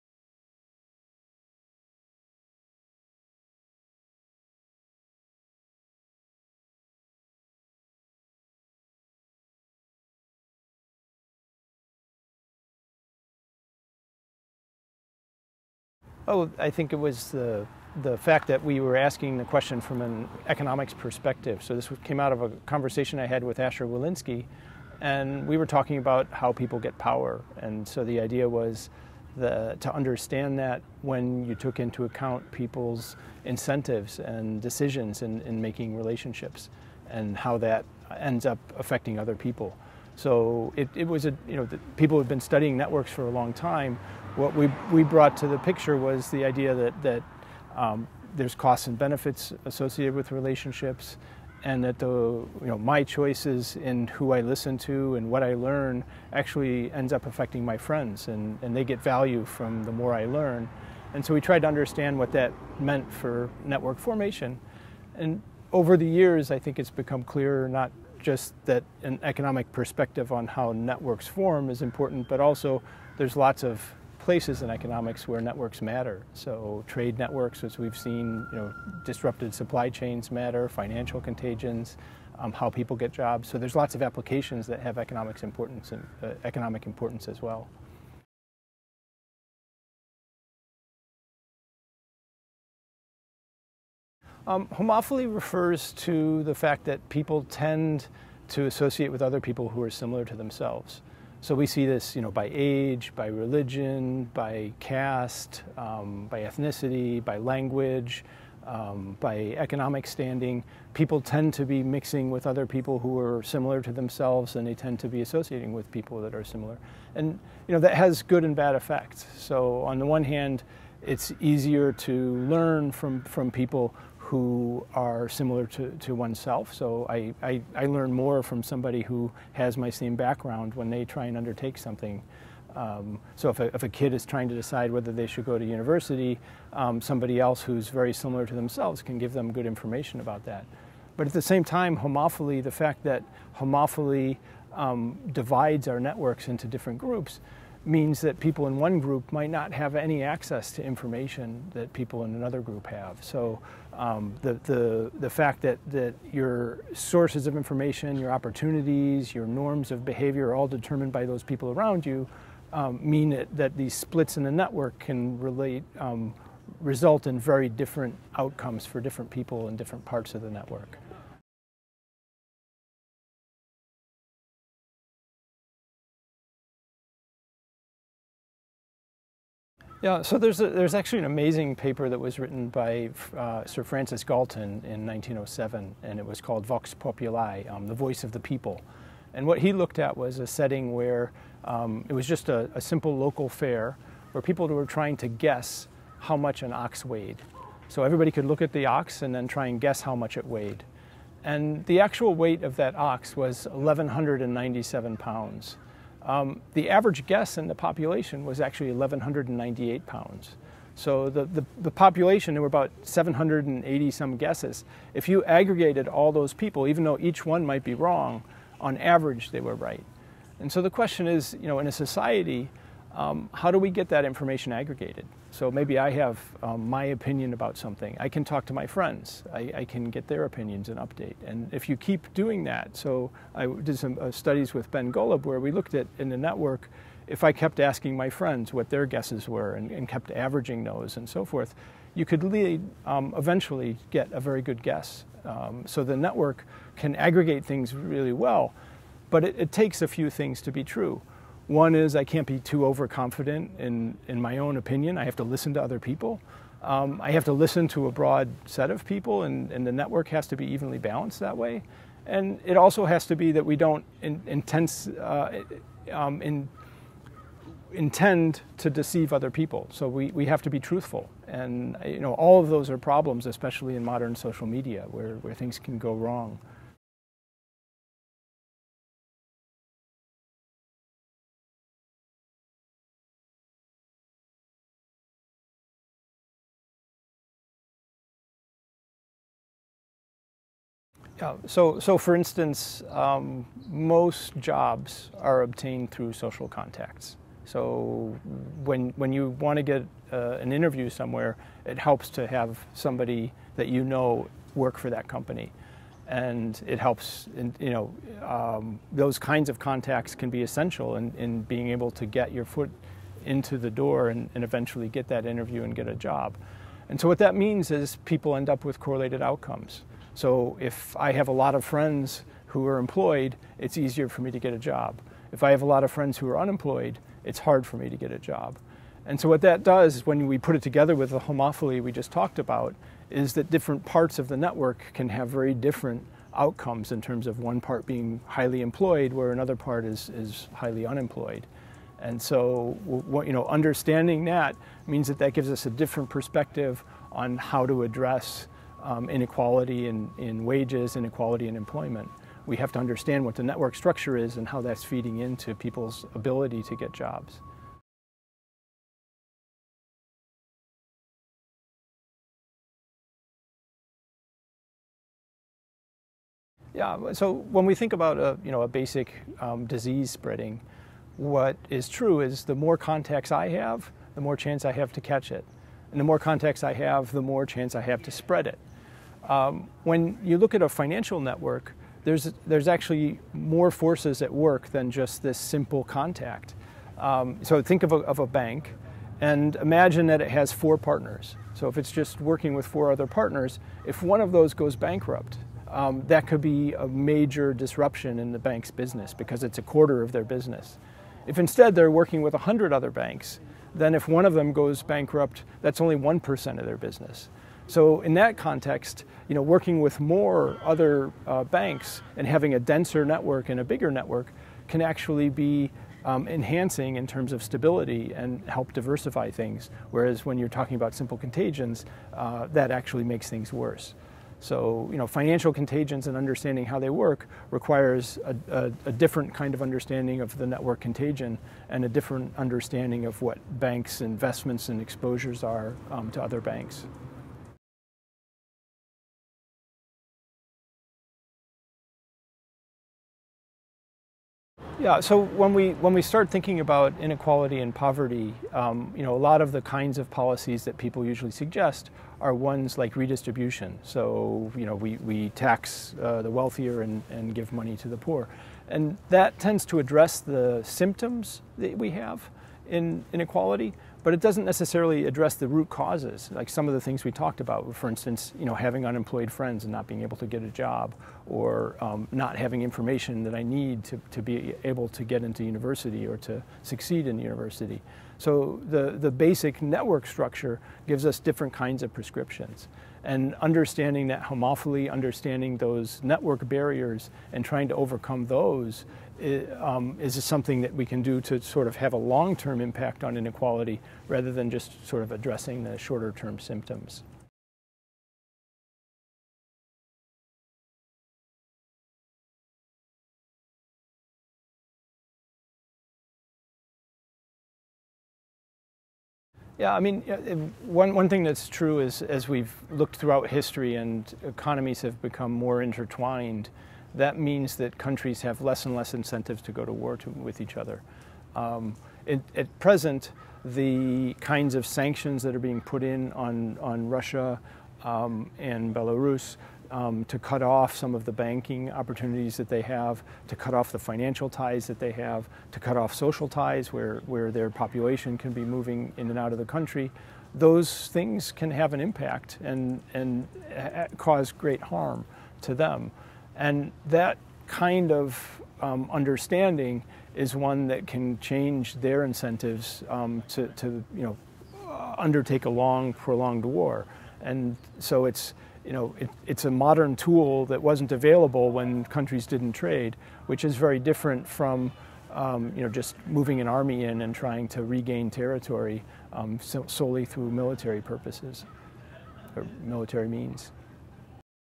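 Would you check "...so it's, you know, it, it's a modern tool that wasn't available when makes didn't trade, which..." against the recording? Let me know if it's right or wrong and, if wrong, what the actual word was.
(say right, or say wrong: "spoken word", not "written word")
wrong: "countries", not "makes".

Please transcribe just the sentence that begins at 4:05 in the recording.
Um, so the network can aggregate things really well, but it, it takes a few things to be true.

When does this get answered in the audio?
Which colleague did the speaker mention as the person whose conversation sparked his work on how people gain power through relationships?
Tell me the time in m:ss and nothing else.
0:23.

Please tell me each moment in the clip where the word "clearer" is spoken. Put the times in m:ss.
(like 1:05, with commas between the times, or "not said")
1:07.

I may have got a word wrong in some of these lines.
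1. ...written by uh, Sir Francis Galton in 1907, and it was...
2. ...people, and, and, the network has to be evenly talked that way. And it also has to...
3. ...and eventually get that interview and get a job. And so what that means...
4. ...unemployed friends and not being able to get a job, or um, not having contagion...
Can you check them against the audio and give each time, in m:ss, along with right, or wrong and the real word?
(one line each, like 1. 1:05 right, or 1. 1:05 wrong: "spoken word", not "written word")
1. 3:02 right
2. 4:19 wrong: "balanced", not "talked"
3. 5:14 right
4. 7:49 wrong: "information", not "contagion".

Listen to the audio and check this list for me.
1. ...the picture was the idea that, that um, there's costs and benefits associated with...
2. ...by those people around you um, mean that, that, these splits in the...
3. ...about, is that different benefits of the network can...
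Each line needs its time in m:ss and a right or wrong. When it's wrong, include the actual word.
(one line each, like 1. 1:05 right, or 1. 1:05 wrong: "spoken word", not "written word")
1. 0:45 right
2. 2:41 right
3. 5:32 wrong: "parts", not "benefits".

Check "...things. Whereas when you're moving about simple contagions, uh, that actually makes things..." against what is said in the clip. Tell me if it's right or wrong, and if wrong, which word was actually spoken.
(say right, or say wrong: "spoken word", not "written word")
wrong: "talking", not "moving".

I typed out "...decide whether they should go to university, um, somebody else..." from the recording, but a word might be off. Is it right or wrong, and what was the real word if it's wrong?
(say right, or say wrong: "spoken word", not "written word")
right.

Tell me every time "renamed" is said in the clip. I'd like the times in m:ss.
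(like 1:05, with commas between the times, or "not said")
not said.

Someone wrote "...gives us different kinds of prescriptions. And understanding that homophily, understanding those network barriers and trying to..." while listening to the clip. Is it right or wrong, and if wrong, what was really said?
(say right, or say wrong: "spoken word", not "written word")
right.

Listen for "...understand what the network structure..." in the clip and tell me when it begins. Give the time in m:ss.
5:52.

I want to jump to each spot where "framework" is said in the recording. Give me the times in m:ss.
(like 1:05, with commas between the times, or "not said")
not said.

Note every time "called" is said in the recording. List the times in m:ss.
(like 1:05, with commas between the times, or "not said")
3:06.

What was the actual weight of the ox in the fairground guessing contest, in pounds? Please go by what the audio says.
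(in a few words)
1,197 pounds.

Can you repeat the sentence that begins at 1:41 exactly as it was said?
So we see this, you know, by age, by religion, by caste, um, by ethnicity, by language, um, by economic standing.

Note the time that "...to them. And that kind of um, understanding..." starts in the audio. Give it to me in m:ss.
9:05.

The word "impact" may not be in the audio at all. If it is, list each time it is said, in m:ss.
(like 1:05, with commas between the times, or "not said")
8:12, 9:01.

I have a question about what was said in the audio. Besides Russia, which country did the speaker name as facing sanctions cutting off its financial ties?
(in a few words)
Belarus.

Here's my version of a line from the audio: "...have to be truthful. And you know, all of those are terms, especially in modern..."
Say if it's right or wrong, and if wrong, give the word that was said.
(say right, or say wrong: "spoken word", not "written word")
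wrong: "problems", not "terms".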